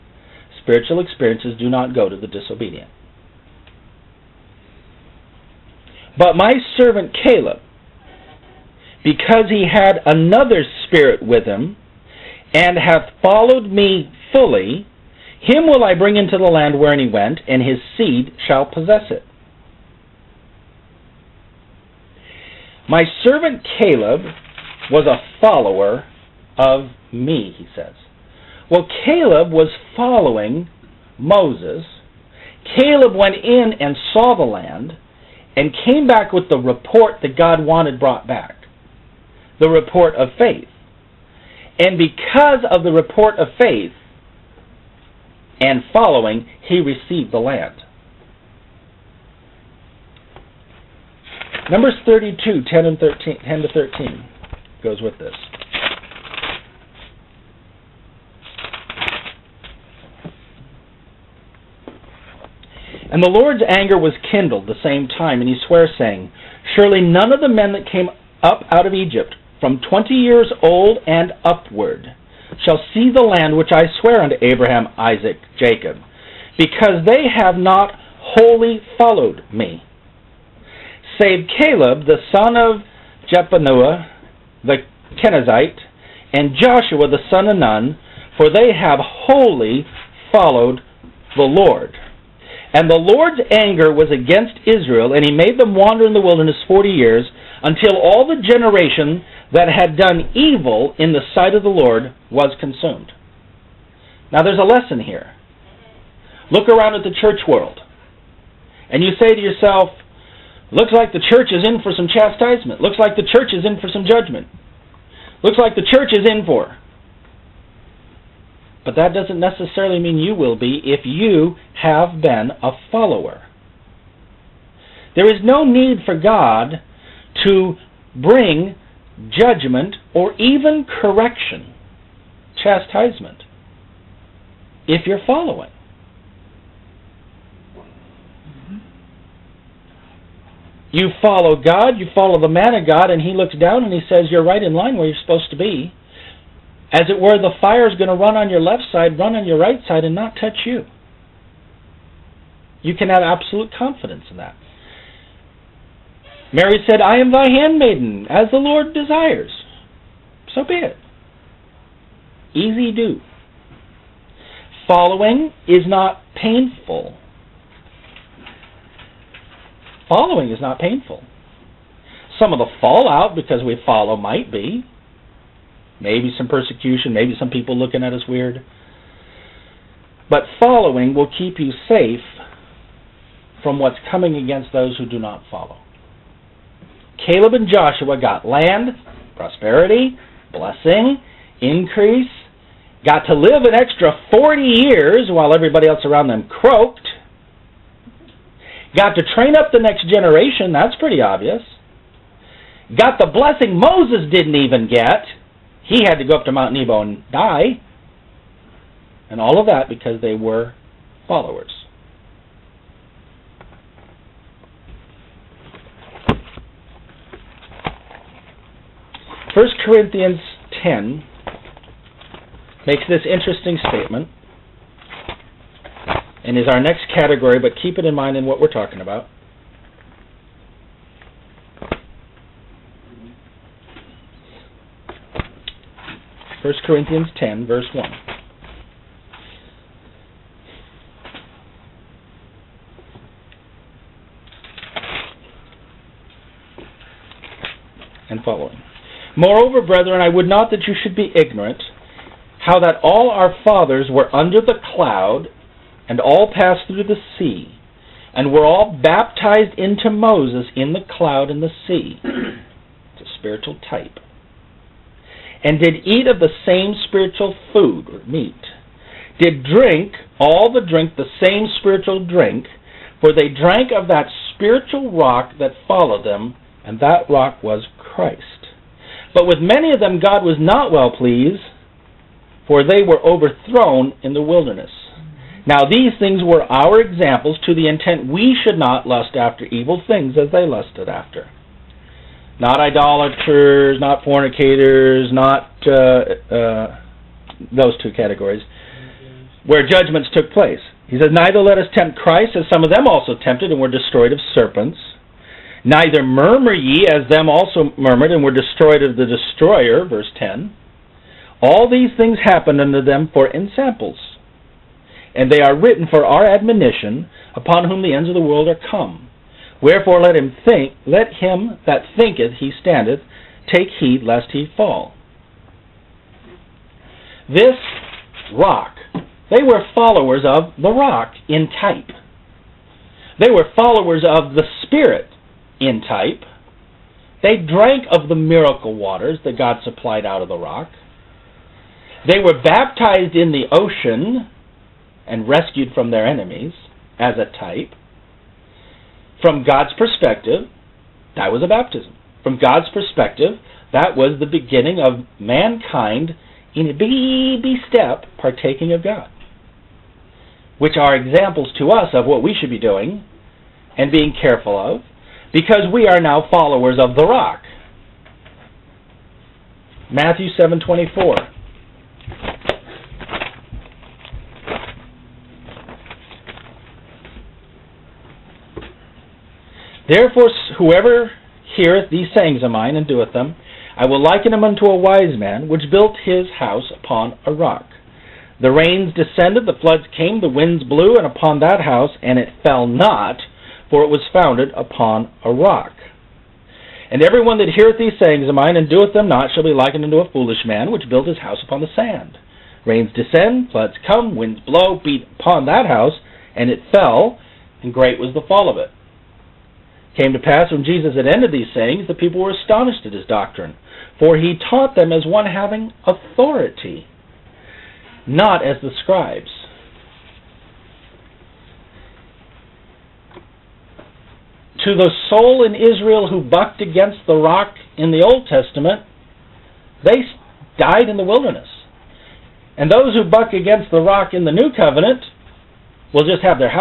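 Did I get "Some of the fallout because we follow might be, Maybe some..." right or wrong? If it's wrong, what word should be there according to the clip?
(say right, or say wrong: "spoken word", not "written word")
right.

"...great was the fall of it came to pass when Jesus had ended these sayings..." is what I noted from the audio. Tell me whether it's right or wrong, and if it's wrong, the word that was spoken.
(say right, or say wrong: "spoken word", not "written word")
right.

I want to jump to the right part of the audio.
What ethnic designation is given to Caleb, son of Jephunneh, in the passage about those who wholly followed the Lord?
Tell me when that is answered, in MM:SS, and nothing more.
01:25.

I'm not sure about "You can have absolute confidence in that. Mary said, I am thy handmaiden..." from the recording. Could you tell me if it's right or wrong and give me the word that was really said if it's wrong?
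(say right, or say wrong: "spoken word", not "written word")
right.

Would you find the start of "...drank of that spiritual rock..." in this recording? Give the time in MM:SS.
04:33.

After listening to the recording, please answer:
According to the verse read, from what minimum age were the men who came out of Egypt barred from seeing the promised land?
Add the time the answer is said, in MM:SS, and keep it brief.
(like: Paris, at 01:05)
20 years old, at 01:09.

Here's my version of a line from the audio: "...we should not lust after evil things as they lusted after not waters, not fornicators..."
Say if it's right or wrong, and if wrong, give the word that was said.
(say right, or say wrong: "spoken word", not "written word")
wrong: "idolaters", not "waters".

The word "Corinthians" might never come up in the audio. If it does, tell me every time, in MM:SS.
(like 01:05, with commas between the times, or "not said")
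03:39, 03:56.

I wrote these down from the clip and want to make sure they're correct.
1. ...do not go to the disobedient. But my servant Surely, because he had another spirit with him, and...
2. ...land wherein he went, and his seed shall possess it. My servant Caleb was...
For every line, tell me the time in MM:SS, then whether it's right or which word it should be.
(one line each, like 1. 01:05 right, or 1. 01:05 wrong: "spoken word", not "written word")
1. 00:01 wrong: "Caleb", not "Surely"
2. 00:16 right.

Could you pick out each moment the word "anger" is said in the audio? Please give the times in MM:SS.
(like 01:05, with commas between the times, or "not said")
01:03, 01:33.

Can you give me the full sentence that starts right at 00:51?
Numbers 32, 10, and 13, 10 to 13 goes with this.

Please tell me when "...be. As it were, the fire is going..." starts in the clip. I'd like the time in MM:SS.
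02:25.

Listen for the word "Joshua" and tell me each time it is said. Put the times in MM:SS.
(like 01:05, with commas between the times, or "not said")
01:26, 03:07.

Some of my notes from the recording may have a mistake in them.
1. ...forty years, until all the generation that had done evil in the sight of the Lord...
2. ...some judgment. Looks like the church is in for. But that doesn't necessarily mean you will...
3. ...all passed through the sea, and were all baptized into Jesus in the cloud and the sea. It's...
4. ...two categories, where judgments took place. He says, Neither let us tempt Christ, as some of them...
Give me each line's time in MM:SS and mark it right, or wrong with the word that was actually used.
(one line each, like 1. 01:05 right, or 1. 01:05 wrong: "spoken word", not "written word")
1. 01:36 right
2. 01:53 right
3. 04:16 wrong: "Moses", not "Jesus"
4. 04:58 right.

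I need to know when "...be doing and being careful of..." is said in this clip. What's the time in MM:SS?
06:02.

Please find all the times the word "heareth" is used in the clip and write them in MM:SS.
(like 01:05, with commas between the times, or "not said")
06:21, 06:37.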